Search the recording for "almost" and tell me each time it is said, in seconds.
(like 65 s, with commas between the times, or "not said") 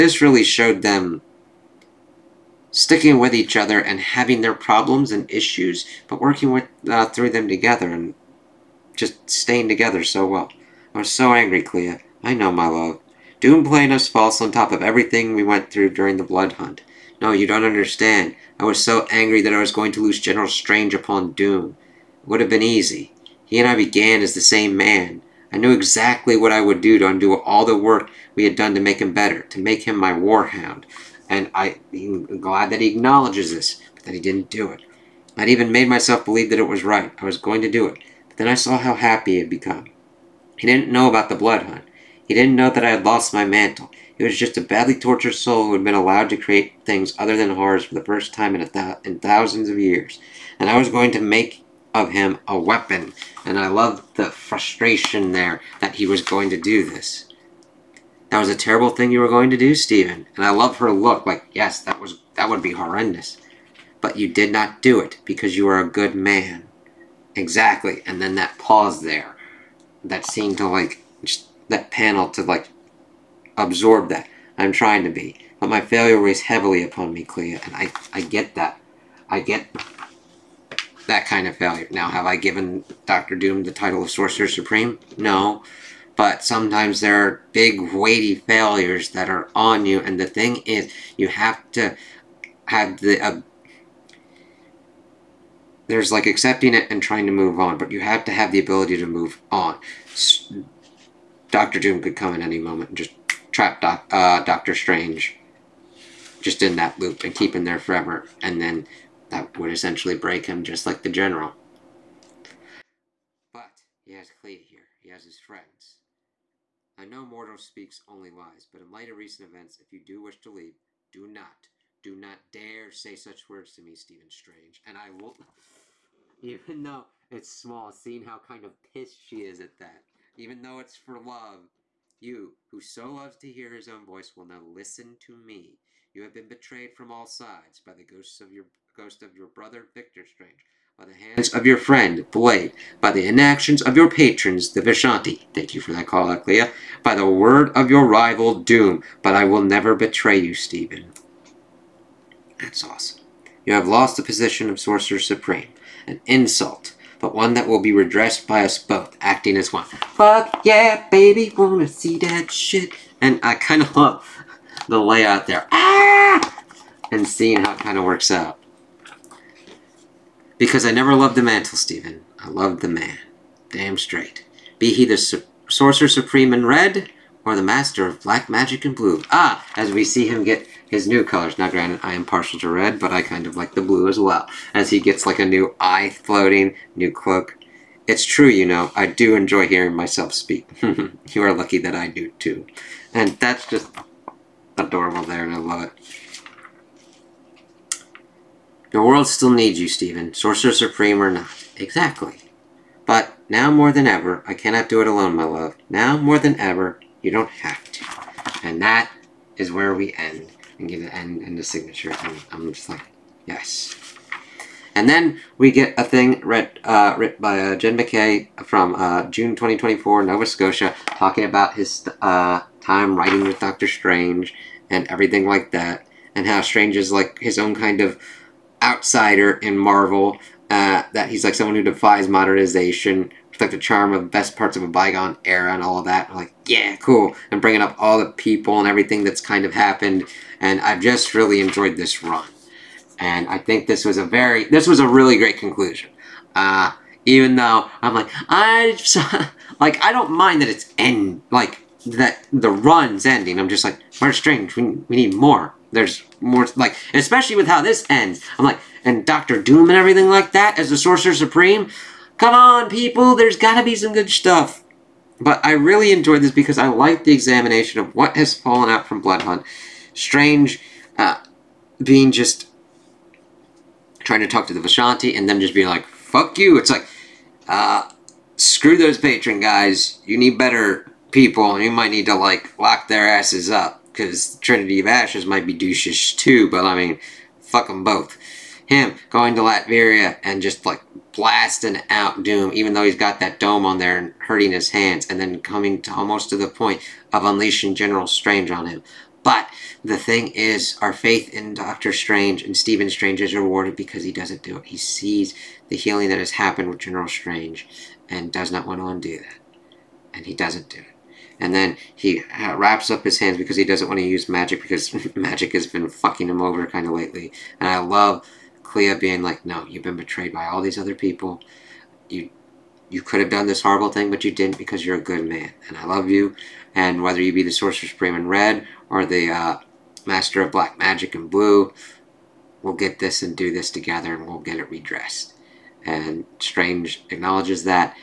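296 s.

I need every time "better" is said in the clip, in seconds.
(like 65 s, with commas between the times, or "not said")
29 s, 280 s.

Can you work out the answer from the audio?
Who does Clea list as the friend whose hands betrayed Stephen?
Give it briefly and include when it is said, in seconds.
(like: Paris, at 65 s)
Blade, at 142 s.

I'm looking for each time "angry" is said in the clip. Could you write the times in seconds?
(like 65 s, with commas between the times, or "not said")
11 s, 19 s.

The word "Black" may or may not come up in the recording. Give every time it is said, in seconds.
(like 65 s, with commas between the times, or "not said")
178 s, 330 s.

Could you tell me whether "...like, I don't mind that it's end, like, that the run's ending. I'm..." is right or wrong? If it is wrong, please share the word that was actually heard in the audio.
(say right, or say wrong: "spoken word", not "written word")
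right.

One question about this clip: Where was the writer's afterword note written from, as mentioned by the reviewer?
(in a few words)
Nova Scotia.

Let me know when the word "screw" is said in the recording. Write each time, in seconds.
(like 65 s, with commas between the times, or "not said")
278 s.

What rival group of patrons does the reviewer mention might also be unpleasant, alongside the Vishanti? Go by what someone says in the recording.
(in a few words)
Trinity of Ashes.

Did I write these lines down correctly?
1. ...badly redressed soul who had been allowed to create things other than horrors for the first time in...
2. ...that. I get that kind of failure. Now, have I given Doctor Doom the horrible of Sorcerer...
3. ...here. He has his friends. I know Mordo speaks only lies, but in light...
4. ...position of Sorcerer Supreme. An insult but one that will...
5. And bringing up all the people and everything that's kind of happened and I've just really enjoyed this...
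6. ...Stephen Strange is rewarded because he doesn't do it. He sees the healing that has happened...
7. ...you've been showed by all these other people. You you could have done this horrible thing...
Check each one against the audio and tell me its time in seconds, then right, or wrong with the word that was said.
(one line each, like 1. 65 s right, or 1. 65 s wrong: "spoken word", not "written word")
1. 44 s wrong: "tortured", not "redressed"
2. 78 s wrong: "title", not "horrible"
3. 114 s right
4. 154 s right
5. 237 s right
6. 302 s right
7. 319 s wrong: "betrayed", not "showed".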